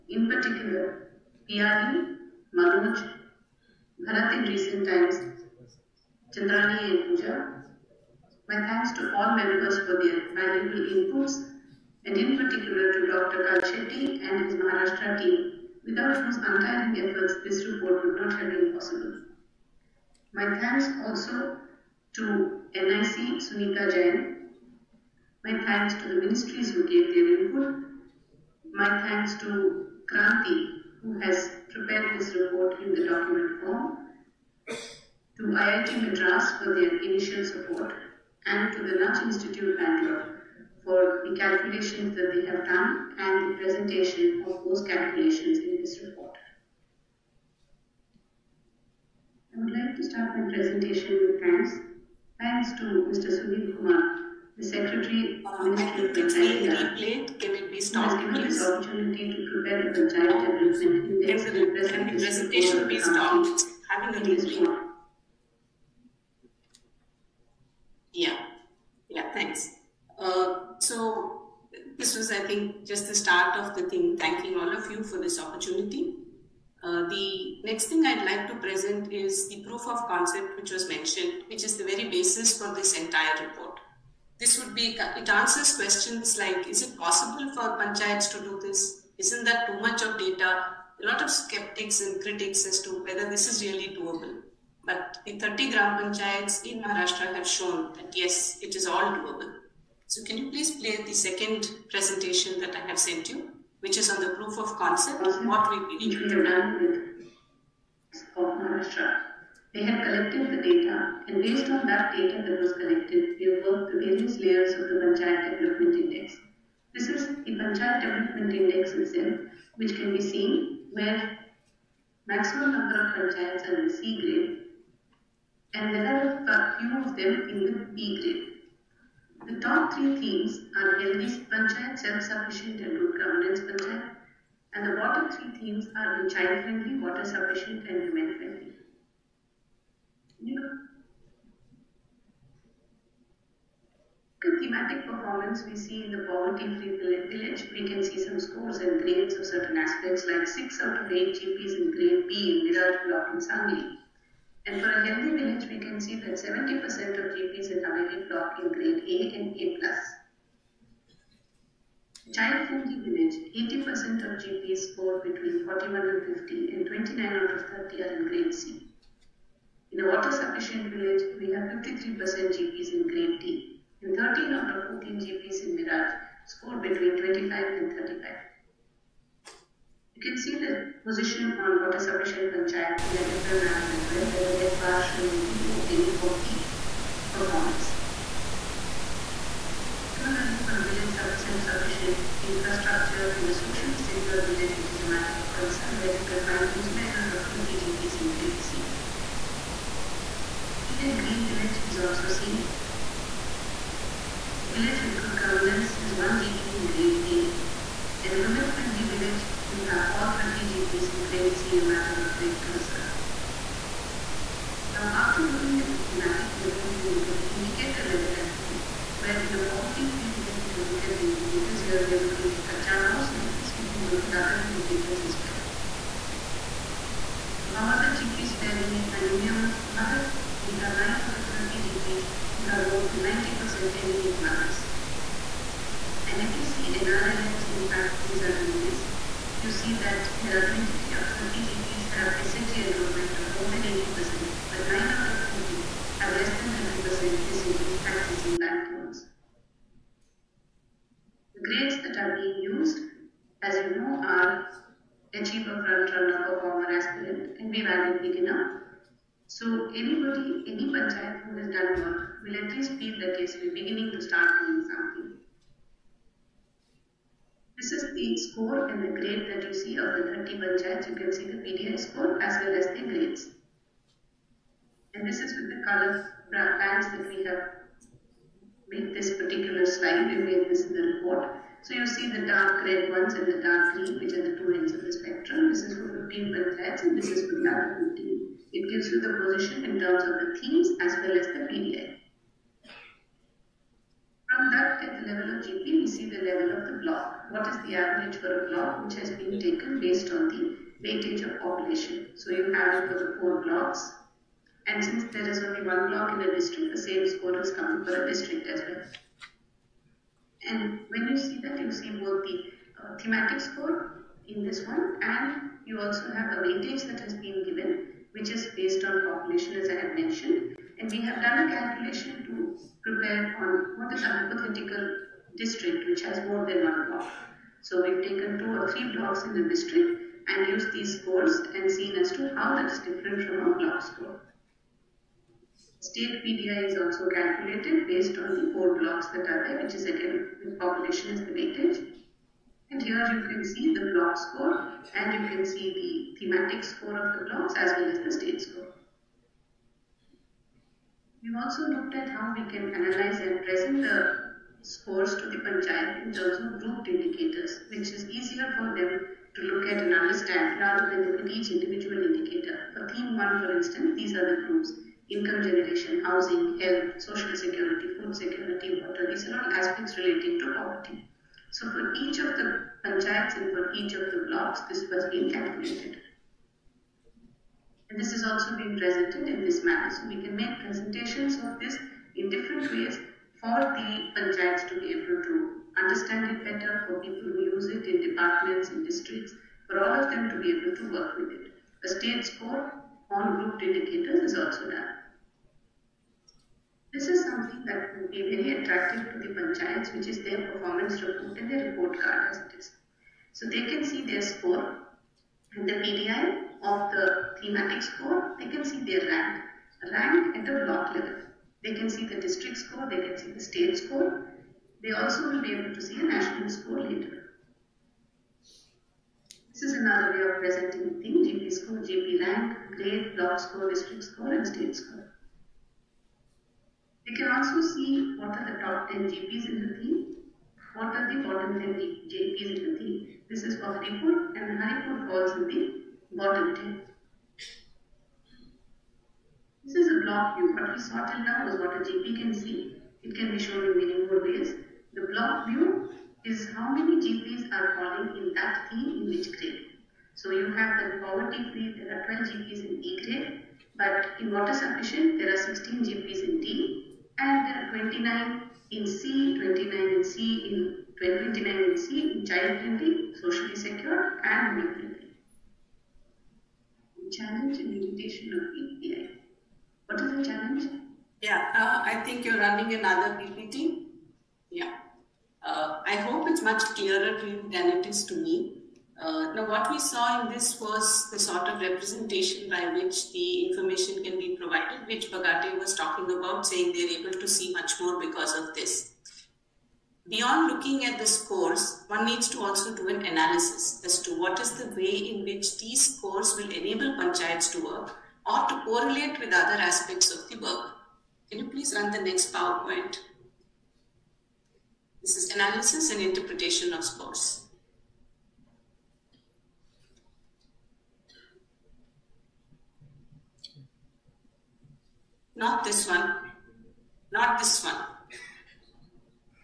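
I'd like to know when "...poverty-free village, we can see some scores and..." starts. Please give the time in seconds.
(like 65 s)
146 s.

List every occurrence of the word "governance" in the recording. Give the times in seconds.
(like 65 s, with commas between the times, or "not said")
133 s, 205 s.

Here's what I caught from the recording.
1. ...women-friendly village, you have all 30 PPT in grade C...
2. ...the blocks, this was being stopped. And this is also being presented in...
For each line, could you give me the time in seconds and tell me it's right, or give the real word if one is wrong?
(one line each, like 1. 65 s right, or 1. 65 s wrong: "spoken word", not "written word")
1. 208 s wrong: "GPs", not "PPT"
2. 374 s wrong: "calculated", not "stopped".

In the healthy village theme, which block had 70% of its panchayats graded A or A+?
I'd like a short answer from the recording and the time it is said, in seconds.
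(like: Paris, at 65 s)
Haveli, at 157 s.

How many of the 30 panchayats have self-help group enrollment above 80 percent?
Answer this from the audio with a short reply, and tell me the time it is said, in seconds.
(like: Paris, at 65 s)
23, at 240 s.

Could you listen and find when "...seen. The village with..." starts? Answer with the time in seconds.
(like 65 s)
202 s.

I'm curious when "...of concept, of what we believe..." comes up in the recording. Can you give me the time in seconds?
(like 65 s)
104 s.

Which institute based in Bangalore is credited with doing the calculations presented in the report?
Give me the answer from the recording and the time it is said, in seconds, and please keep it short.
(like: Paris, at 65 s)
Nudge Institute, at 38 s.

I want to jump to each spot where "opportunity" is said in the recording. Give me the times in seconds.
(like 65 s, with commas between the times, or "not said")
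58 s, 75 s.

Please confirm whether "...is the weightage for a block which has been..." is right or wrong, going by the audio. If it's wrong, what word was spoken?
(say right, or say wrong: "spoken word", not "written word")
wrong: "average", not "weightage".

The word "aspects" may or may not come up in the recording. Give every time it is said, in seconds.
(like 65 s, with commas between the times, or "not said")
149 s, 369 s, 499 s.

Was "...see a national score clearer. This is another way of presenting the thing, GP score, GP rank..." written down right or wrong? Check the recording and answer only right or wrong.
wrong.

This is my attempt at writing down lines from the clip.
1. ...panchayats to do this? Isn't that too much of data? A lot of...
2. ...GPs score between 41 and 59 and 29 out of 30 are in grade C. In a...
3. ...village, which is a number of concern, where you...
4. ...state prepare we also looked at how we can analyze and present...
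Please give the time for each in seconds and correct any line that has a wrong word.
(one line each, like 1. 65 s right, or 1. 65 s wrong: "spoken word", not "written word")
1. 87 s right
2. 164 s wrong: "50", not "59"
3. 194 s wrong: "matter", not "number"
4. 348 s wrong: "score", not "prepare".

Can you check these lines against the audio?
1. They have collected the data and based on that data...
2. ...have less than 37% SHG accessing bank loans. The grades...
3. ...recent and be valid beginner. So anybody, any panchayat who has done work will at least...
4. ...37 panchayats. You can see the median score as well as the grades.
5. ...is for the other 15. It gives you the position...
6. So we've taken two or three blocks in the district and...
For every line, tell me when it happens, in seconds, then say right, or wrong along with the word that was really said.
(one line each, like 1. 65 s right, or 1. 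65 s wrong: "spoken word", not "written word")
1. 109 s right
2. 246 s wrong: "30", not "37"
3. 256 s wrong: "aspirant", not "recent"
4. 270 s wrong: "30", not "37"
5. 287 s right
6. 327 s right.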